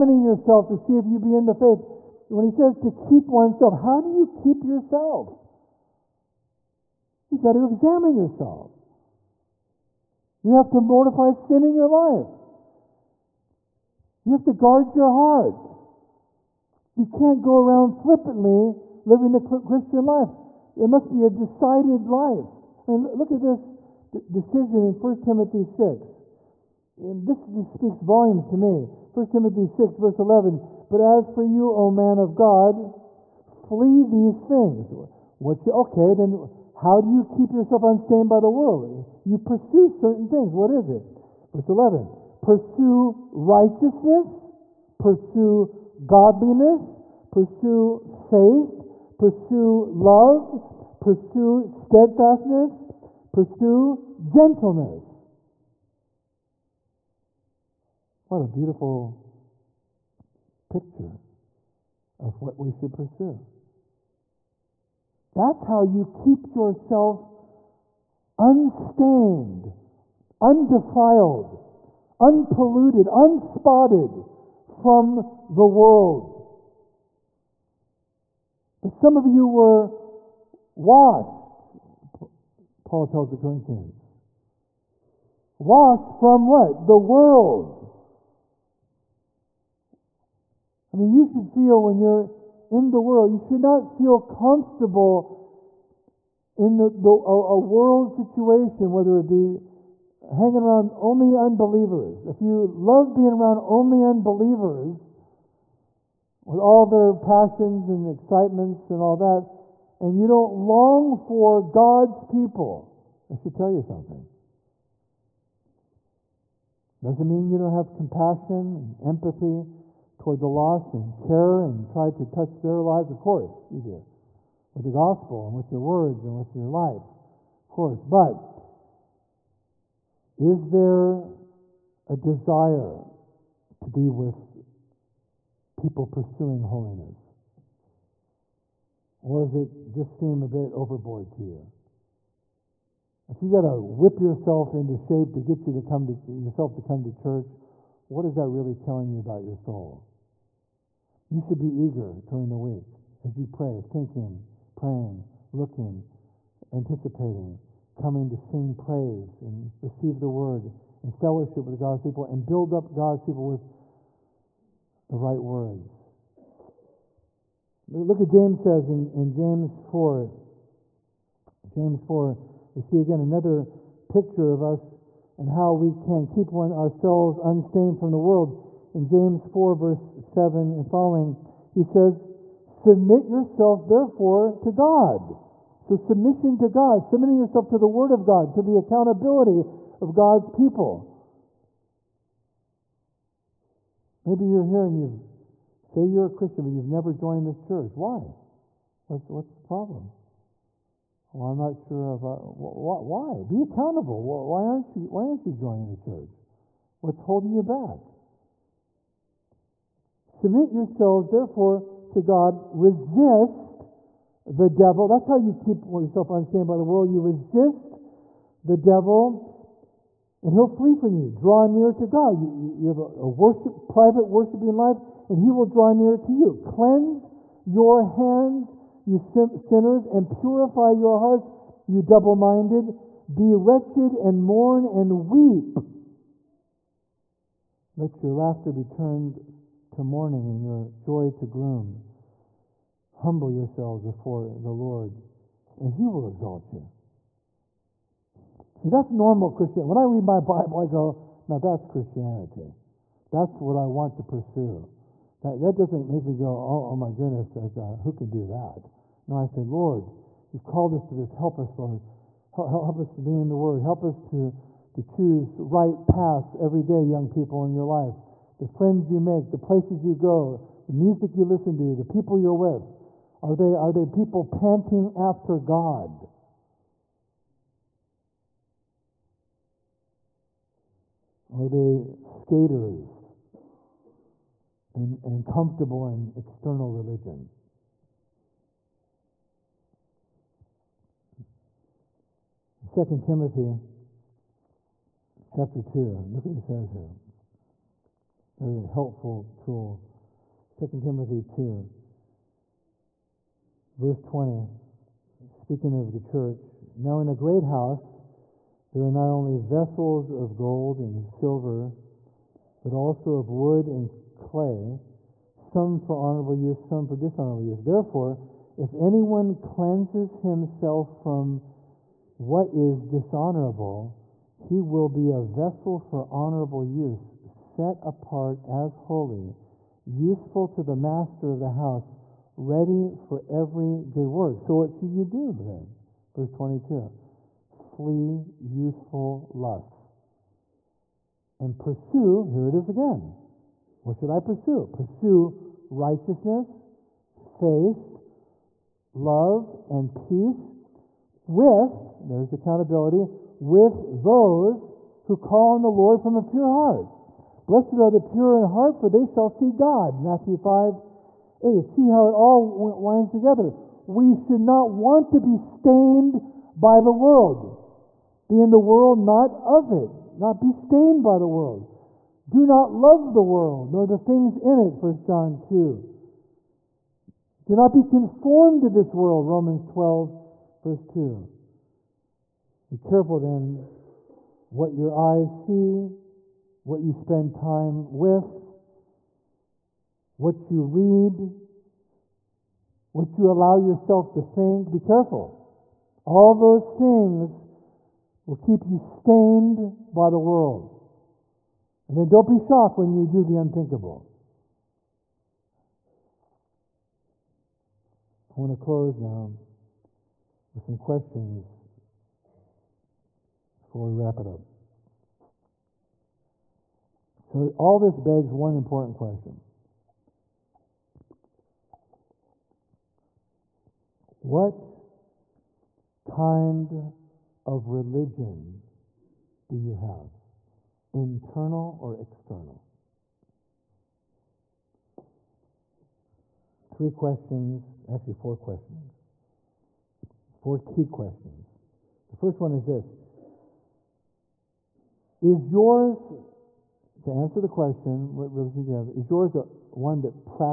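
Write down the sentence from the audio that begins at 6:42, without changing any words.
And then don't be shocked when you do the unthinkable.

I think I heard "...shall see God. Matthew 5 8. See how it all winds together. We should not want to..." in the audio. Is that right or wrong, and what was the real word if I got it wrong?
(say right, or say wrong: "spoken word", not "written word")
right.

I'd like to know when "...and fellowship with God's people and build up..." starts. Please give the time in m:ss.
2:41.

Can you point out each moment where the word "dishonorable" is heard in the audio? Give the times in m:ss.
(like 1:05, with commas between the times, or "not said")
5:17, 5:23.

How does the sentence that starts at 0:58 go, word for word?
What a beautiful picture of what we should pursue.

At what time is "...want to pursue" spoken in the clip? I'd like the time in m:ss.
4:13.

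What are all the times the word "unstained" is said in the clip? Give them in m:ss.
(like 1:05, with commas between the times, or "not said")
0:37, 1:08, 2:57, 3:36.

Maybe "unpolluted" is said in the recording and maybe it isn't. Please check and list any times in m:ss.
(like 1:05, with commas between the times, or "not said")
1:12.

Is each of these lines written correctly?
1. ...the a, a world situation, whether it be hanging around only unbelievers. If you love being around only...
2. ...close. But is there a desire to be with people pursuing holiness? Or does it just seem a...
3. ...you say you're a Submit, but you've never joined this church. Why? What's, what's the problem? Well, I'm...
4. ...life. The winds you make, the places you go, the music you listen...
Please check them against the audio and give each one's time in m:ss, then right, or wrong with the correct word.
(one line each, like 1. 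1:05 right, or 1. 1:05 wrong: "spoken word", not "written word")
1. 1:36 right
2. 2:07 wrong: "course", not "close"
3. 3:14 wrong: "Christian", not "Submit"
4. 4:27 wrong: "friends", not "winds".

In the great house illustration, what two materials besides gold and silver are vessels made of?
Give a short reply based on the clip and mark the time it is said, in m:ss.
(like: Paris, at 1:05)
Wood and clay, at 5:13.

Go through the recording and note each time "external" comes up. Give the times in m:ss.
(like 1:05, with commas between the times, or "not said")
4:46, 7:12.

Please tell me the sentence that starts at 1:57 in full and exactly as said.
Doesn't mean you don't have compassion and empathy toward the lost and care and try to touch their lives?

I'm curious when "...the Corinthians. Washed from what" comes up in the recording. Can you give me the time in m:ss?
1:23.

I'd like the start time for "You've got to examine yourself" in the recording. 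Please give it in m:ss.
0:07.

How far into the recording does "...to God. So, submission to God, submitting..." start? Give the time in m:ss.
3:04.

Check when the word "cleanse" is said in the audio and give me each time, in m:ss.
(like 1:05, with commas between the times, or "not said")
3:46, 5:19.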